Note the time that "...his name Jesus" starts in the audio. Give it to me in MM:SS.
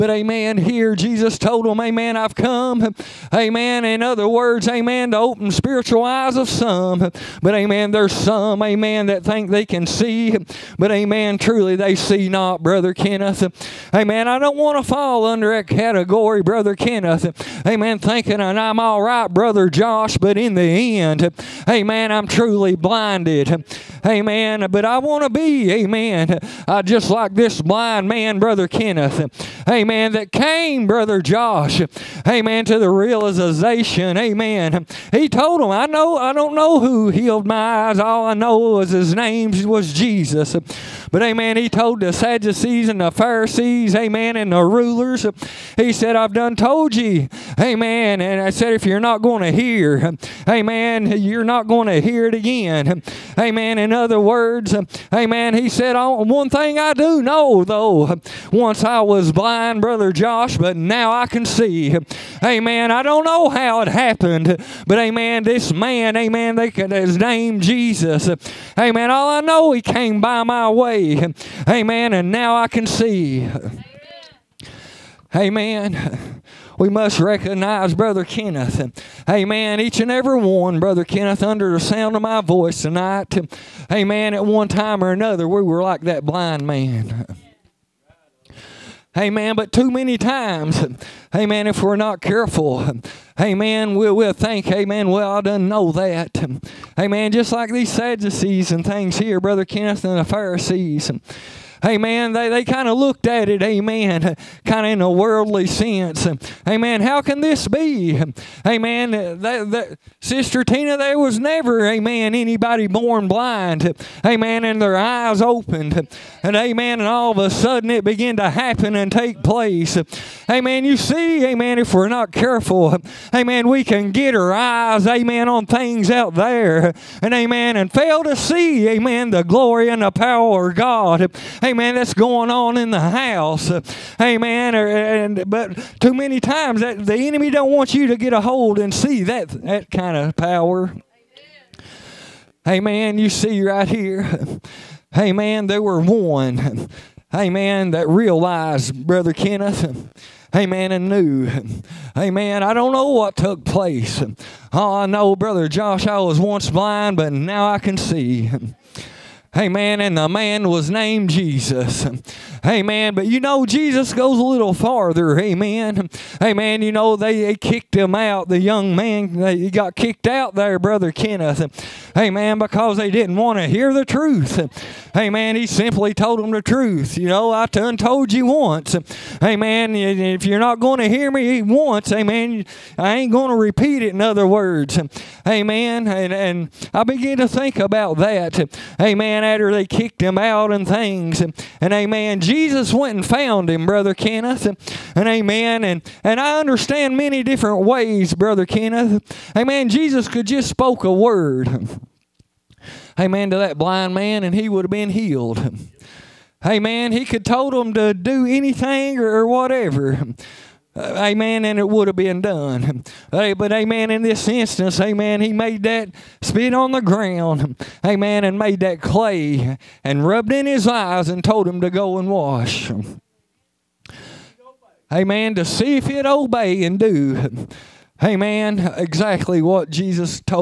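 01:06.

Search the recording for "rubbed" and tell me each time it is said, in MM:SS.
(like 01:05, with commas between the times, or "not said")
03:40.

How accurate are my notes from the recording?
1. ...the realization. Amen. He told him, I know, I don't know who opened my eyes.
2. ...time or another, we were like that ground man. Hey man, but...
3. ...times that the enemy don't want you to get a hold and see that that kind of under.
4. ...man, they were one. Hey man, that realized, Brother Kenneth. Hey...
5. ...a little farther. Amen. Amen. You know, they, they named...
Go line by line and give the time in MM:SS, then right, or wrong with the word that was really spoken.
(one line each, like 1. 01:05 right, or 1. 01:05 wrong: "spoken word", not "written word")
1. 00:32 wrong: "healed", not "opened"
2. 01:24 wrong: "blind", not "ground"
3. 02:16 wrong: "power", not "under"
4. 02:25 right
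5. 02:44 wrong: "kicked", not "named".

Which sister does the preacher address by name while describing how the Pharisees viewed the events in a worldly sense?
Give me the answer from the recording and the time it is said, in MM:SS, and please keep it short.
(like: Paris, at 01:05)
Sister Tina, at 01:50.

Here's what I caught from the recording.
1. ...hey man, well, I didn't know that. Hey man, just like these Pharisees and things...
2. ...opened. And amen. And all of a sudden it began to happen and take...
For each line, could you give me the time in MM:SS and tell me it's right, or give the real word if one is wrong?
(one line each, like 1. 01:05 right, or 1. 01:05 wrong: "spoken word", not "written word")
1. 01:34 wrong: "Sadducees", not "Pharisees"
2. 01:55 right.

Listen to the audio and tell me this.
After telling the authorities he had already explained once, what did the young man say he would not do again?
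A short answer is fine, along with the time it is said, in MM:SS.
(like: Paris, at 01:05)
repeat it, at 03:03.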